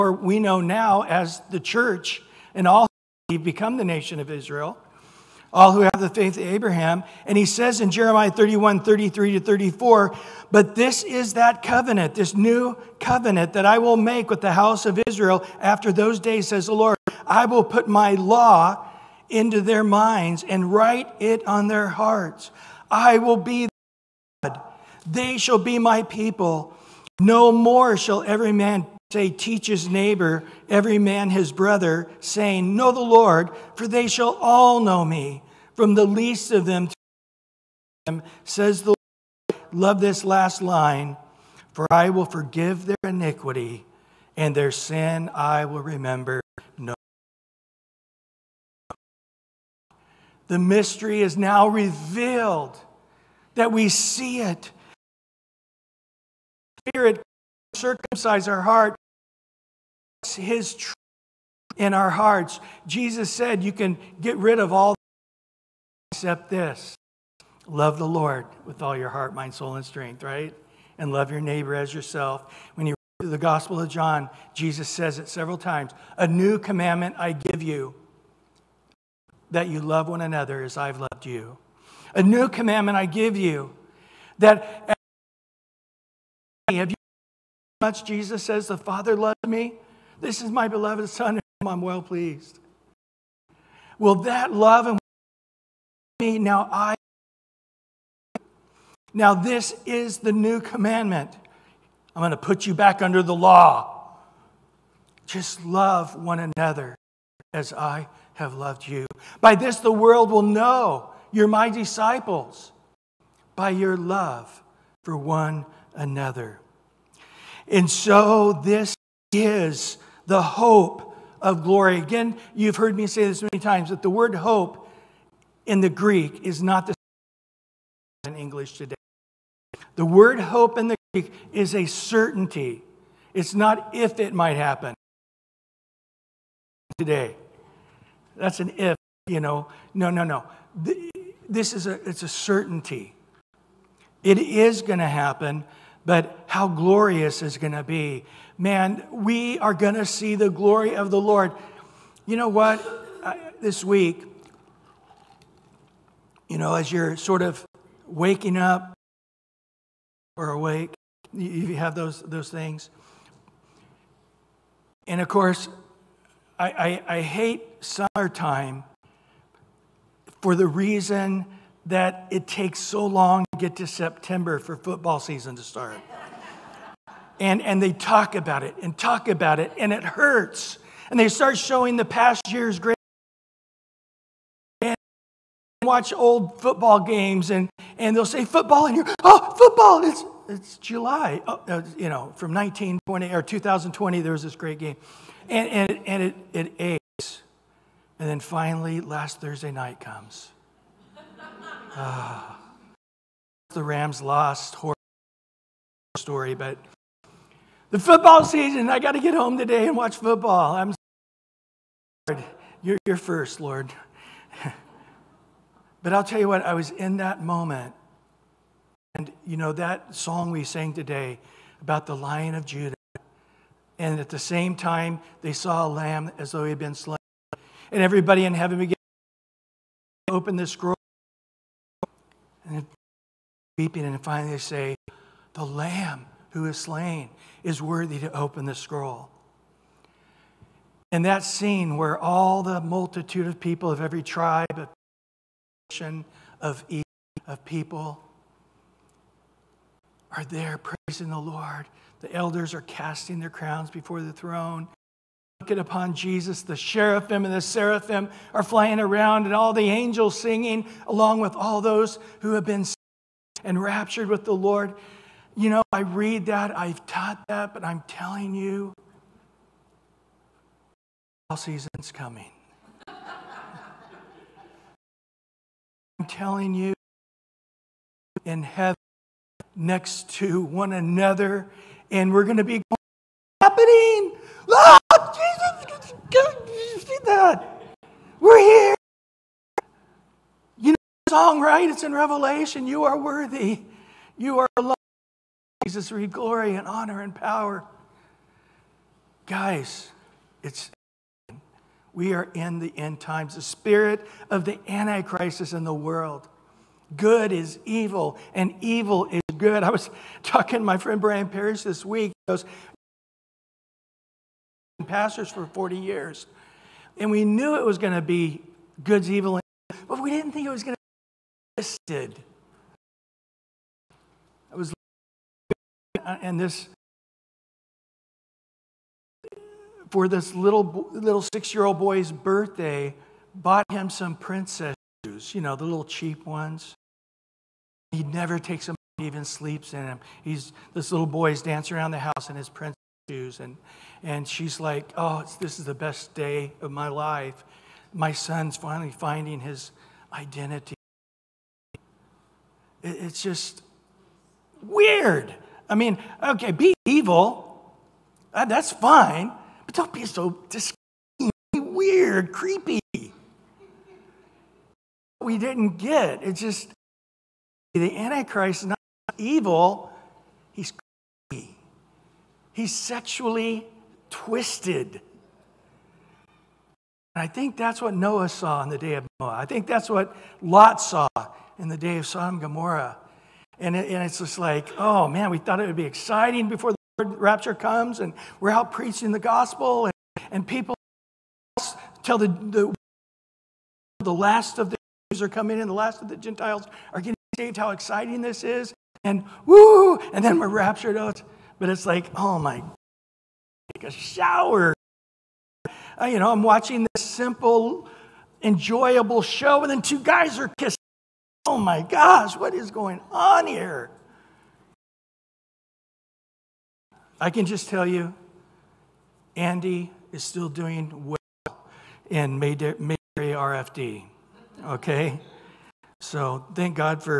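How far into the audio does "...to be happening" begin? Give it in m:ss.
4:42.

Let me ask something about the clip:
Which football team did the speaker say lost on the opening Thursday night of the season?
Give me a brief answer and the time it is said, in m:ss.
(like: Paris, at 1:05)
The Rams, at 3:23.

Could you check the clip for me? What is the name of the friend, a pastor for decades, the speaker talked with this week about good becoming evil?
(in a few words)
Brian Parrish.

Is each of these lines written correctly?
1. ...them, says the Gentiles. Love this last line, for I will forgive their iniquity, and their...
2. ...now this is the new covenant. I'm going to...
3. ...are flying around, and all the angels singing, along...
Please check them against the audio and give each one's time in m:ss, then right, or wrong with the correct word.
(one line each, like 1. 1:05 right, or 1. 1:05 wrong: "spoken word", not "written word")
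1. 0:38 wrong: "Lord", not "Gentiles"
2. 1:39 wrong: "commandment", not "covenant"
3. 4:18 right.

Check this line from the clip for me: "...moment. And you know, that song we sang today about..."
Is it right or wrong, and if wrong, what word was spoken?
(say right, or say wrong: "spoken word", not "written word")
right.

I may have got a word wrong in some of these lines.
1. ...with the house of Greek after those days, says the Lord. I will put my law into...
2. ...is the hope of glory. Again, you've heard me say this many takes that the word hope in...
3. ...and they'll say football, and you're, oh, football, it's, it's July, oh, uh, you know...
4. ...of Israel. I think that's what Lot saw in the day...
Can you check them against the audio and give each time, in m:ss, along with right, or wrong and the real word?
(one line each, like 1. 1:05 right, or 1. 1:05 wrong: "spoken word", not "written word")
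1. 0:14 wrong: "Israel", not "Greek"
2. 1:59 wrong: "times", not "takes"
3. 3:07 right
4. 6:19 wrong: "Noah", not "Israel".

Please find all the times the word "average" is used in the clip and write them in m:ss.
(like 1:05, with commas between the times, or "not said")
not said.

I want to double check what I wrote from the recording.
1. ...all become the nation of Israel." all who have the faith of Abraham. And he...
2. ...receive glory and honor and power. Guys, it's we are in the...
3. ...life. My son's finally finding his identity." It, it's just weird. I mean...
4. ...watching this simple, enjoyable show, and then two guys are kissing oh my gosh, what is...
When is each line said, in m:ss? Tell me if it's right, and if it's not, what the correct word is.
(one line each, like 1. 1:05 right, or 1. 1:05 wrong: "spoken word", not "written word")
1. 0:02 right
2. 4:56 right
3. 5:47 right
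4. 6:46 right.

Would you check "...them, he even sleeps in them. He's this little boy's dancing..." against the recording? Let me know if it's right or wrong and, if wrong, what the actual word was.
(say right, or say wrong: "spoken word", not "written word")
right.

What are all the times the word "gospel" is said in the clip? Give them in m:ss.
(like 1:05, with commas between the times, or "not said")
1:13, 6:29.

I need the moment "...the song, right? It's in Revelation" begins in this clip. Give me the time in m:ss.
4:51.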